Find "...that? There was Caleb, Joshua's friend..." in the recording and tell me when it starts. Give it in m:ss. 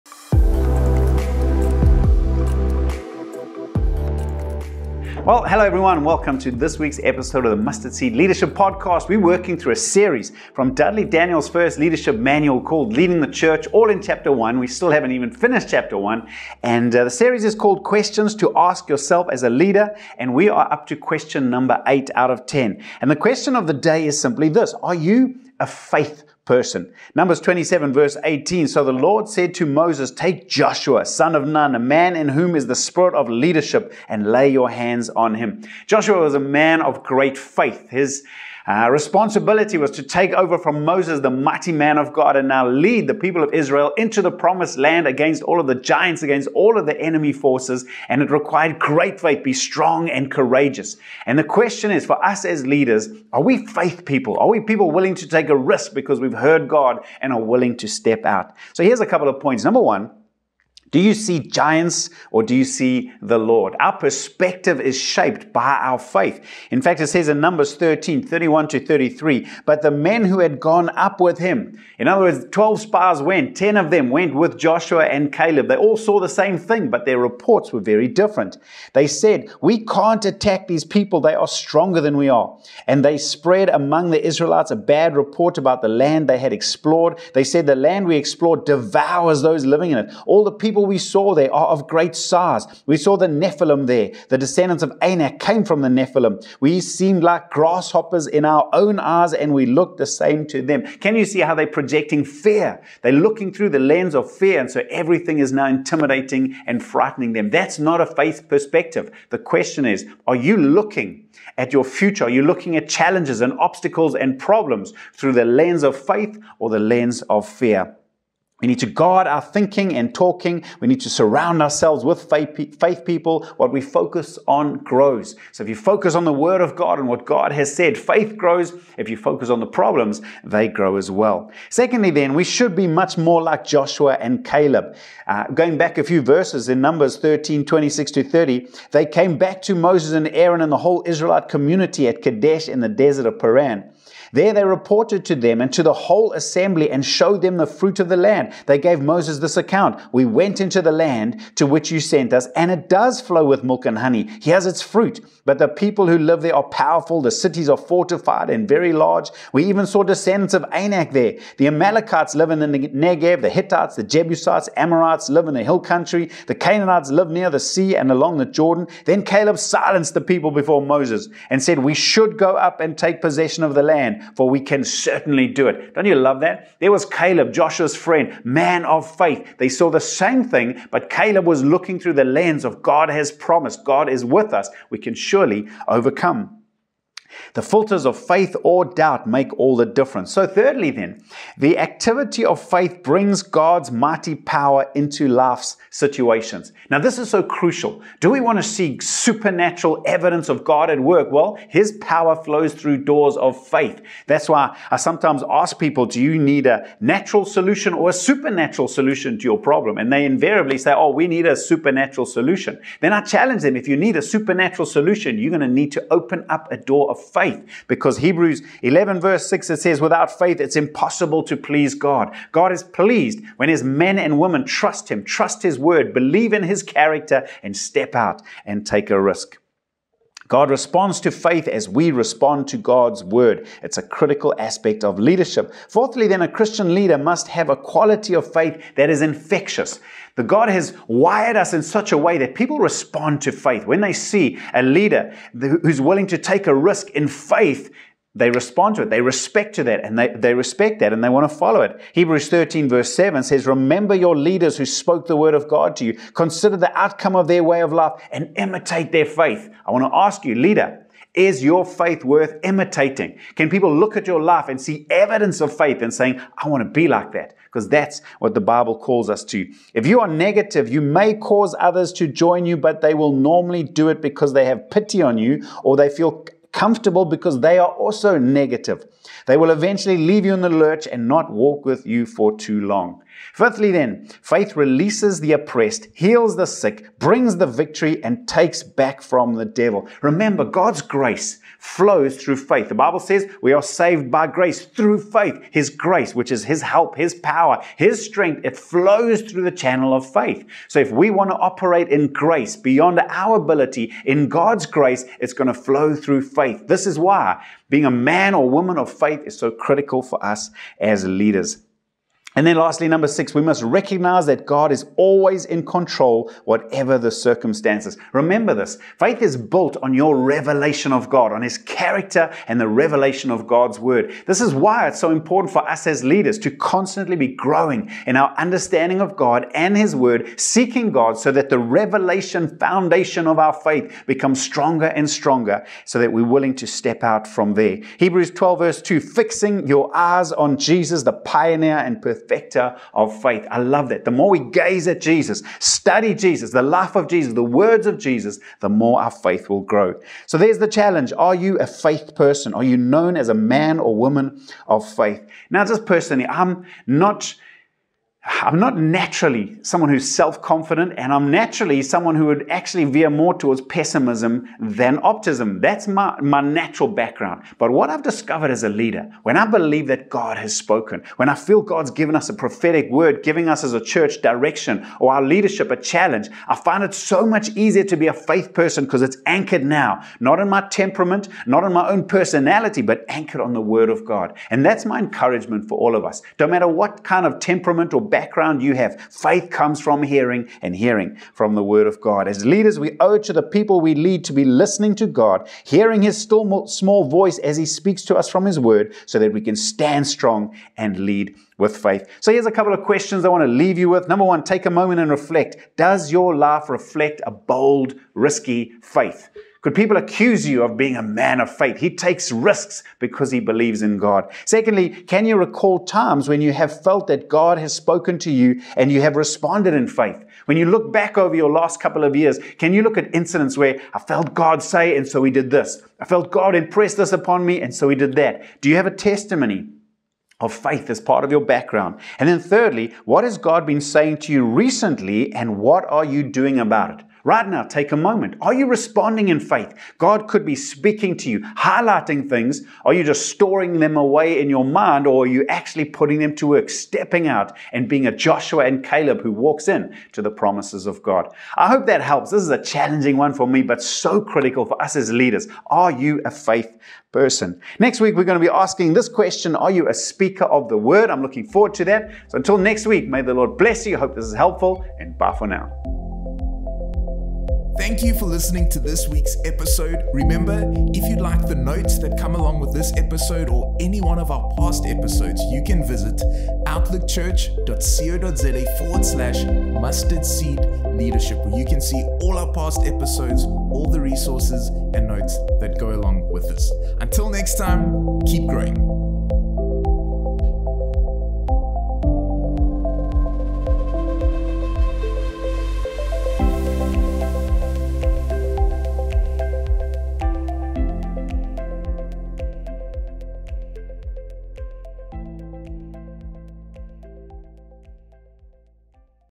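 2:56.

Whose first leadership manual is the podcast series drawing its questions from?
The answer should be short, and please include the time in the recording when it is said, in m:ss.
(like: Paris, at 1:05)
Dudley Daniel, at 0:10.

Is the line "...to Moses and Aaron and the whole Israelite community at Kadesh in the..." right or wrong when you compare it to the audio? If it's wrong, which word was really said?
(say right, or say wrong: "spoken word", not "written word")
right.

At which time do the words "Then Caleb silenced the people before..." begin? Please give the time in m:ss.
2:49.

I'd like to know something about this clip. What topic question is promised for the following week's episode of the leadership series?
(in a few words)
Are you a speaker of the word?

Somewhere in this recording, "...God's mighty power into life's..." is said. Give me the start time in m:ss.
3:13.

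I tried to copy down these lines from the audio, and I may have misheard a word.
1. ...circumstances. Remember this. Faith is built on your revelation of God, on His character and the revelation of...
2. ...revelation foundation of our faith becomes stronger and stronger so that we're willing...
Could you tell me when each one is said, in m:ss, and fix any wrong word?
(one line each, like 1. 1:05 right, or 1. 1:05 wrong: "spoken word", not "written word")
1. 5:17 right
2. 5:31 right.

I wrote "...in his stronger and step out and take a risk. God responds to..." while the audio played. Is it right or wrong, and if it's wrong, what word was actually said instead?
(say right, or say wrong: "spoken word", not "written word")
wrong: "character", not "stronger".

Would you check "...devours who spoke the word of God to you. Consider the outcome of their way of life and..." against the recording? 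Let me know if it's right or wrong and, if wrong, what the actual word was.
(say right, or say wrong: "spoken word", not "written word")
wrong: "leaders", not "devours".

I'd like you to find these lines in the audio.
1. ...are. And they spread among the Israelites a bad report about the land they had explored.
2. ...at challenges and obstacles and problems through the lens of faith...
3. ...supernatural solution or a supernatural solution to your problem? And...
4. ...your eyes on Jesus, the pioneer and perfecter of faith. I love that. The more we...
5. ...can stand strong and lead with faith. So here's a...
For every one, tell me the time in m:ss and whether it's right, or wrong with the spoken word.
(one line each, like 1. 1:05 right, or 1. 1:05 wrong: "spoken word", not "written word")
1. 1:22 right
2. 1:52 right
3. 3:27 wrong: "natural", not "supernatural"
4. 5:39 right
5. 6:39 right.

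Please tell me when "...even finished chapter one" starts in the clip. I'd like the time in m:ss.
0:15.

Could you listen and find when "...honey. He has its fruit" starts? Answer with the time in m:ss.
2:33.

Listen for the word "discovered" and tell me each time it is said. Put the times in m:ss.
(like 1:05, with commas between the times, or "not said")
6:08.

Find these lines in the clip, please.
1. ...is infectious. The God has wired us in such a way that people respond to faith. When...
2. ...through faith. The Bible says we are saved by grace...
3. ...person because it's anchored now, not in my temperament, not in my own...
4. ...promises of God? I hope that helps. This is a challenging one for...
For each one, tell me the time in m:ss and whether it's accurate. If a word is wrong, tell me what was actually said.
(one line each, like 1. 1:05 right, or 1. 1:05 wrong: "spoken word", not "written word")
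1. 3:59 right
2. 4:52 right
3. 6:18 right
4. 7:30 right.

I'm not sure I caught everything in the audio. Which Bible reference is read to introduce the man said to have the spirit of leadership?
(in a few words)
Numbers 27:18.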